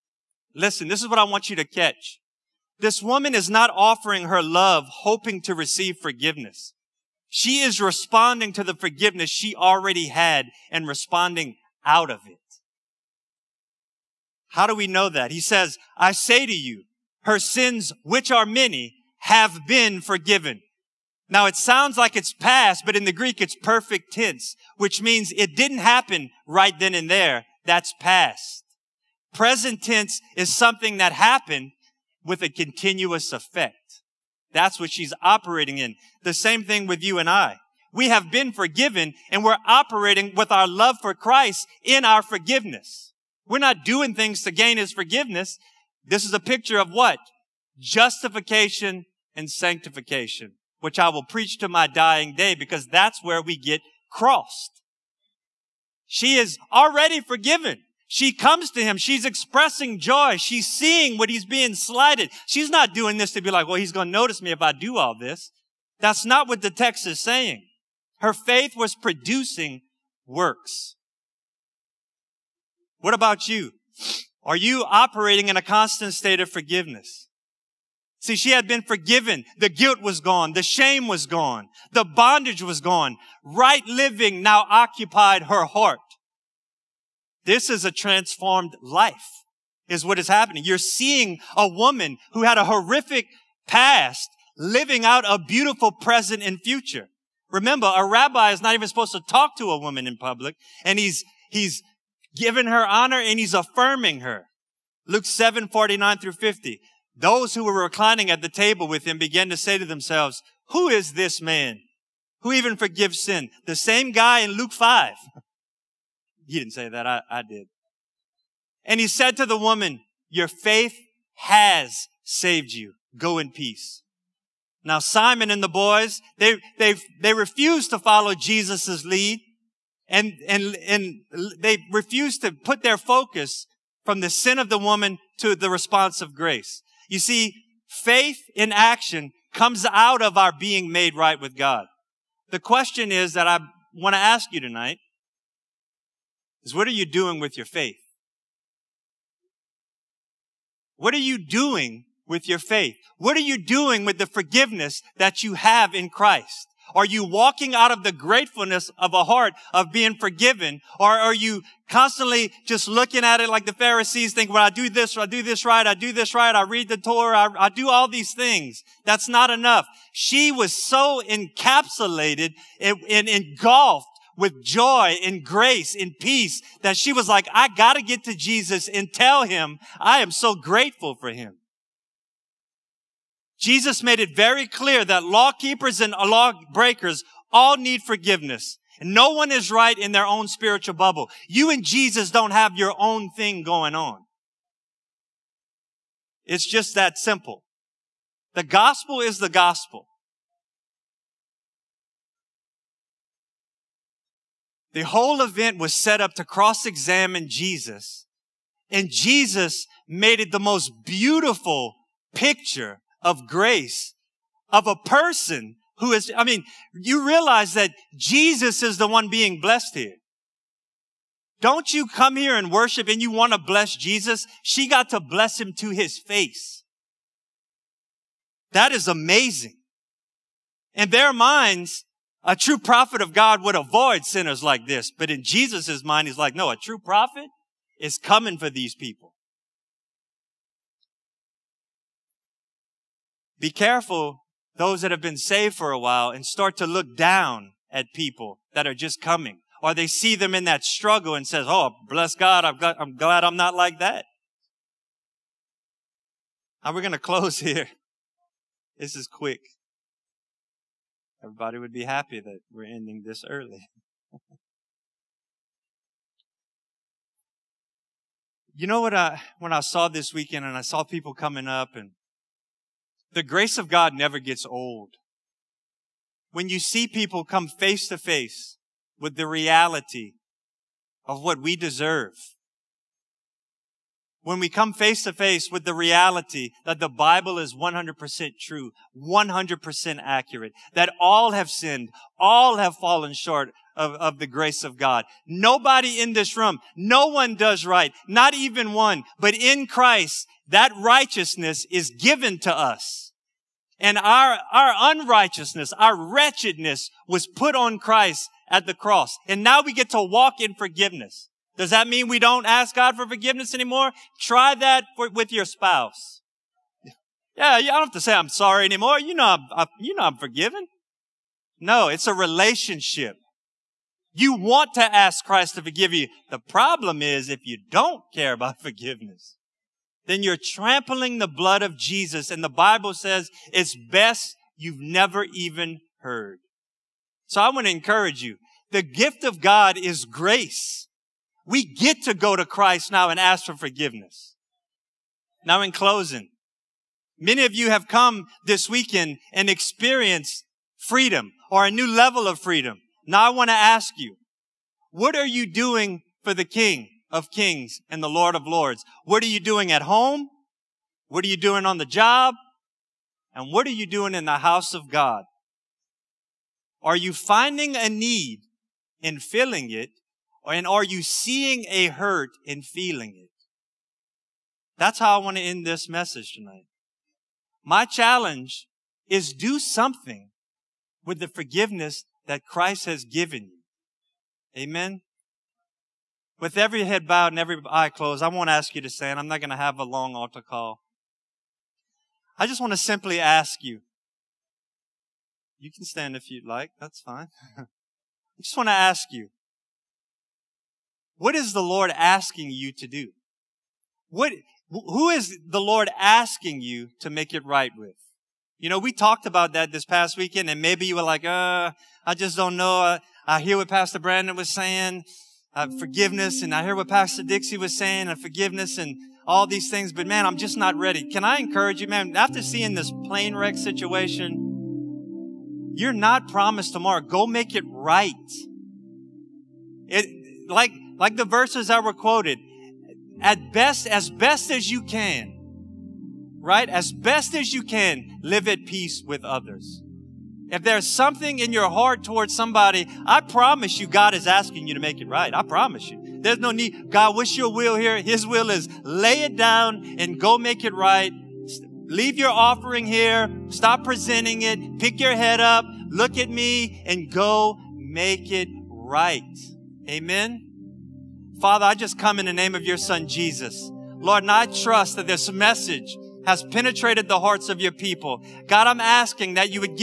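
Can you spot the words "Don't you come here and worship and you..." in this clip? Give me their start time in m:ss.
3:41.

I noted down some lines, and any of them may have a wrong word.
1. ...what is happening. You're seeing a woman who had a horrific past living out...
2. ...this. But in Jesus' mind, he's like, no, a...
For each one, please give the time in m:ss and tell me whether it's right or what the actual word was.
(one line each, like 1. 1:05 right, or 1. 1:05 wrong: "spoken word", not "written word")
1. 1:30 right
2. 3:54 right.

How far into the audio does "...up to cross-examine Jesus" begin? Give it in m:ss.
3:26.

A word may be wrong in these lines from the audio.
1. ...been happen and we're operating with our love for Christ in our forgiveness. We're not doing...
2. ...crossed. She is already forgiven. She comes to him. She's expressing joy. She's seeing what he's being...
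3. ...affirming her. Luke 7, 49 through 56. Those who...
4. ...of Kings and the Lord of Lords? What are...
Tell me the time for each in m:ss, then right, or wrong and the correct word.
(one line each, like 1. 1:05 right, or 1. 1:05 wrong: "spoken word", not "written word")
1. 0:38 wrong: "forgiven", not "happen"
2. 0:54 right
3. 1:43 wrong: "50", not "56"
4. 5:57 right.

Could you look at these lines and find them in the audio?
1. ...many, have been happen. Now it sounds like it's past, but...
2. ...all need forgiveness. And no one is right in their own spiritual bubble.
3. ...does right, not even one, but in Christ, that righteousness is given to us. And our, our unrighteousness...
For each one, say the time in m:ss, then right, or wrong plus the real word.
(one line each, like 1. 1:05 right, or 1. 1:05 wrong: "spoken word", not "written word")
1. 0:18 wrong: "forgiven", not "happen"
2. 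3:07 right
3. 4:57 right.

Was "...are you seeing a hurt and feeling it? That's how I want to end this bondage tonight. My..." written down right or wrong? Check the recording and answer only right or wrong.
wrong.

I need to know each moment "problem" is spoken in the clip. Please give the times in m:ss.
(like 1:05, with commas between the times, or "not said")
5:26.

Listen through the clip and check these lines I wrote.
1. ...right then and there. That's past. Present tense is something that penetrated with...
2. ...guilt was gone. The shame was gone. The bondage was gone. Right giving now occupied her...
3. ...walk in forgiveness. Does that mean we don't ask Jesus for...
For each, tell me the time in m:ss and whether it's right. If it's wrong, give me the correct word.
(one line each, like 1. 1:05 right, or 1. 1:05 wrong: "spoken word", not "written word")
1. 0:26 wrong: "happened", not "penetrated"
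2. 1:19 wrong: "living", not "giving"
3. 5:10 wrong: "God", not "Jesus".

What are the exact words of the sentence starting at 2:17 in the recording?
You see, faith in action comes out of our being made right with God.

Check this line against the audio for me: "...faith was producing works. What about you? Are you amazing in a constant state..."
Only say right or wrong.
wrong.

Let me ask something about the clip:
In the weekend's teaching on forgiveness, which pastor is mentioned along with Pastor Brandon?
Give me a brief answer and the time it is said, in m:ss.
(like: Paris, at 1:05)
Pastor Dixie, at 6:57.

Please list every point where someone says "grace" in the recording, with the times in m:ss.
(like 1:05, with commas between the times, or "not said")
2:16, 2:55, 3:33, 4:33, 4:54, 5:40.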